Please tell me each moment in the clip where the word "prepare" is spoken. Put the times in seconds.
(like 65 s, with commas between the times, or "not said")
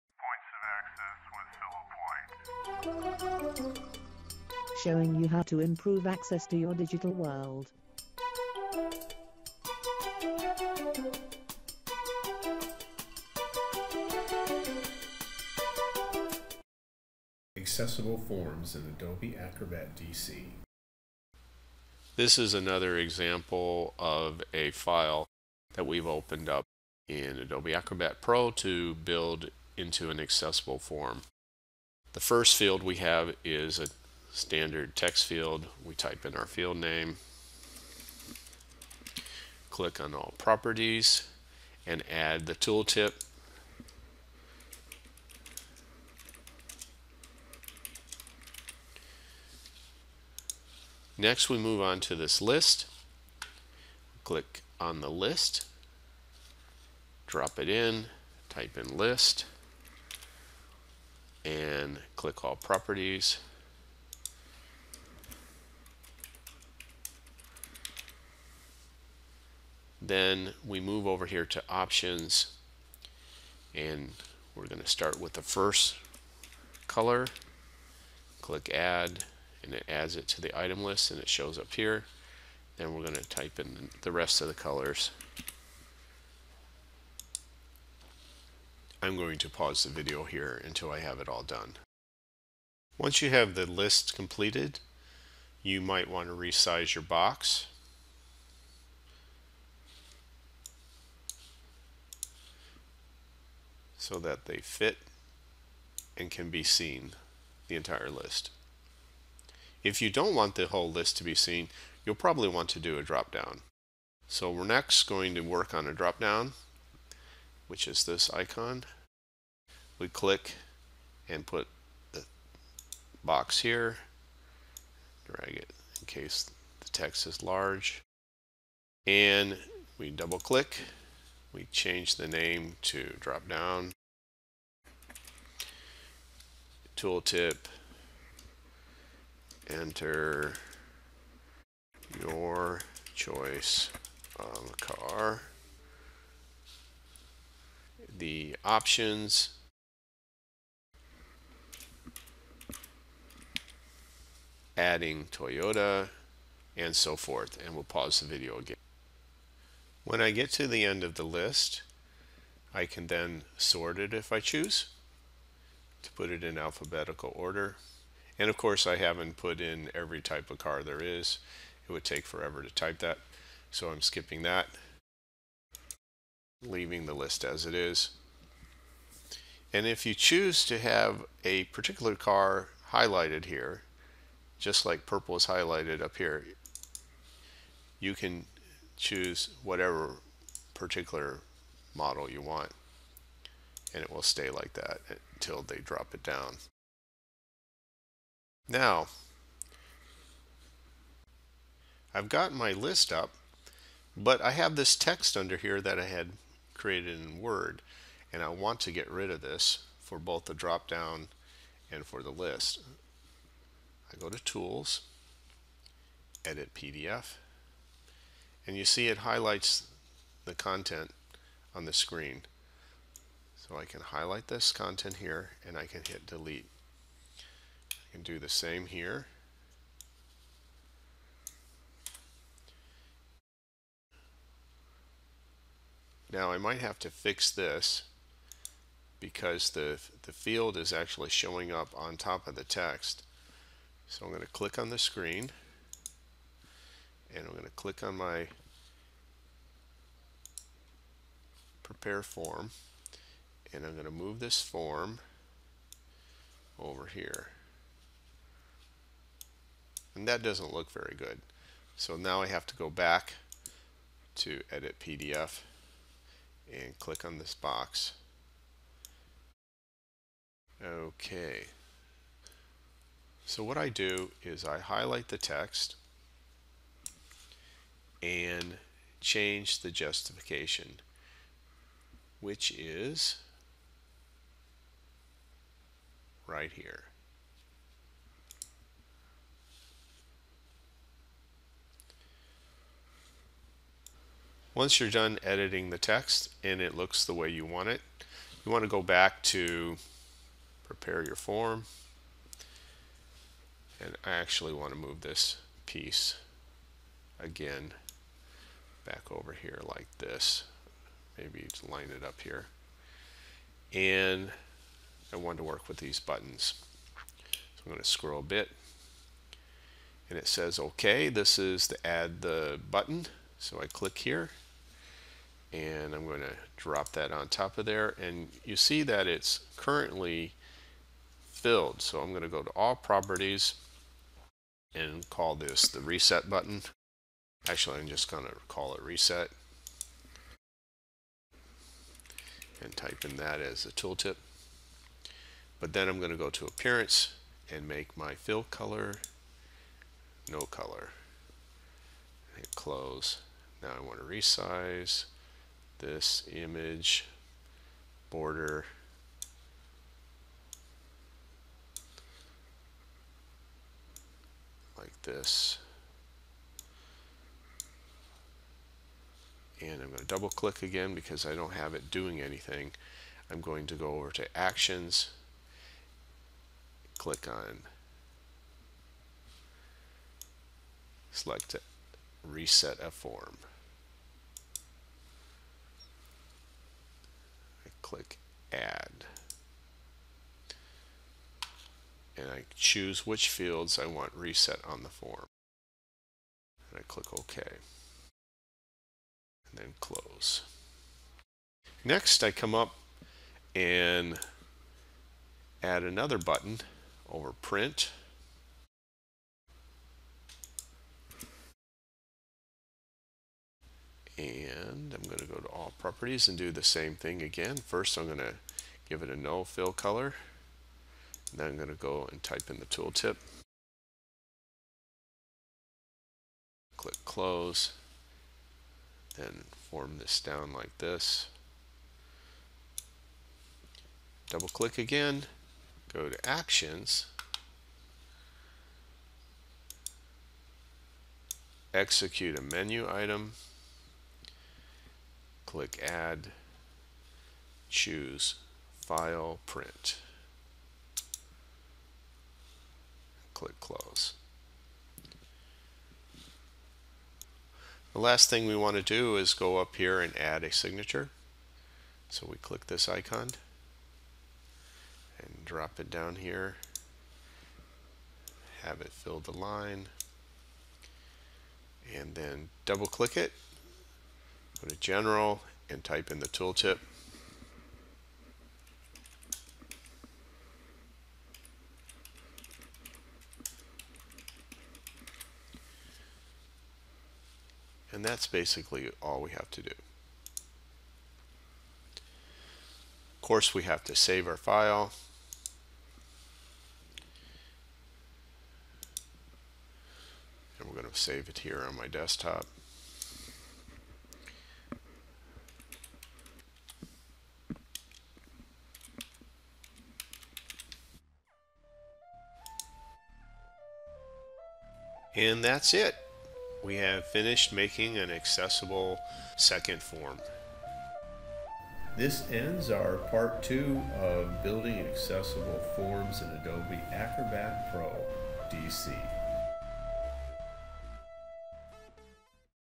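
251 s, 300 s.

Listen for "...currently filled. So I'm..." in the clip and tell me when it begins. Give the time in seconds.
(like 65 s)
329 s.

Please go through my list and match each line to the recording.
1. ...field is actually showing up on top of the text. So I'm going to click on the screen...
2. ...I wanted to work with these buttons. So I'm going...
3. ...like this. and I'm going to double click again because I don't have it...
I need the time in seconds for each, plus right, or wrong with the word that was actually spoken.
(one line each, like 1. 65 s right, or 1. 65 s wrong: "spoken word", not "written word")
1. 240 s right
2. 315 s right
3. 364 s right.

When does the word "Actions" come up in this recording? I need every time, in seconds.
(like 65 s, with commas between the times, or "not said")
374 s, 436 s.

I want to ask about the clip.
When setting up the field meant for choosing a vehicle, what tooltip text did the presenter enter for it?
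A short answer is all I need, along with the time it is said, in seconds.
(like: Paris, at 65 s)
enter your choice of car, at 139 s.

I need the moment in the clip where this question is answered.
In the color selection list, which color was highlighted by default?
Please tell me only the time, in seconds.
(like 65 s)
185 s.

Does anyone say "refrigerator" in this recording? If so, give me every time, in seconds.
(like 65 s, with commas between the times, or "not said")
not said.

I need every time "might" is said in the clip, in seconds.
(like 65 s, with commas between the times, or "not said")
95 s, 236 s.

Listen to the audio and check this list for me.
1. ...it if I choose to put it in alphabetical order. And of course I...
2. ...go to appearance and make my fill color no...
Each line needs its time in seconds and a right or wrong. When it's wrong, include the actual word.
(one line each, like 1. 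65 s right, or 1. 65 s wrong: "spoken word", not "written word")
1. 163 s right
2. 346 s right.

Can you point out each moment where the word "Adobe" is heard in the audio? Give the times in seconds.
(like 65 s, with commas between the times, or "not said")
18 s, 27 s, 526 s.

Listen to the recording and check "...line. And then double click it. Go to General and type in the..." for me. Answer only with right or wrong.
right.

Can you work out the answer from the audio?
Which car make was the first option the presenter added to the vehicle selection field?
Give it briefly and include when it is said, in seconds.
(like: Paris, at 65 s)
Toyota, at 155 s.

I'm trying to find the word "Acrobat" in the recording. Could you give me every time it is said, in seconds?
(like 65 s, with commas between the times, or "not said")
19 s, 27 s, 527 s.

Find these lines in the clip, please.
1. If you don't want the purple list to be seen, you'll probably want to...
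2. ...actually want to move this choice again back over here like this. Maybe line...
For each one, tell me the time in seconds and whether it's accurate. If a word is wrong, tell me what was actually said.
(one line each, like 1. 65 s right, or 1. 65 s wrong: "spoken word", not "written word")
1. 109 s wrong: "whole", not "purple"
2. 304 s wrong: "piece", not "choice".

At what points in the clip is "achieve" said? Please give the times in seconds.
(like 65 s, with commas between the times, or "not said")
not said.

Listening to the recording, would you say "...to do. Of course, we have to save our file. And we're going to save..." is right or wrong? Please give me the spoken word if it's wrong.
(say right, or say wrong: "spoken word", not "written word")
right.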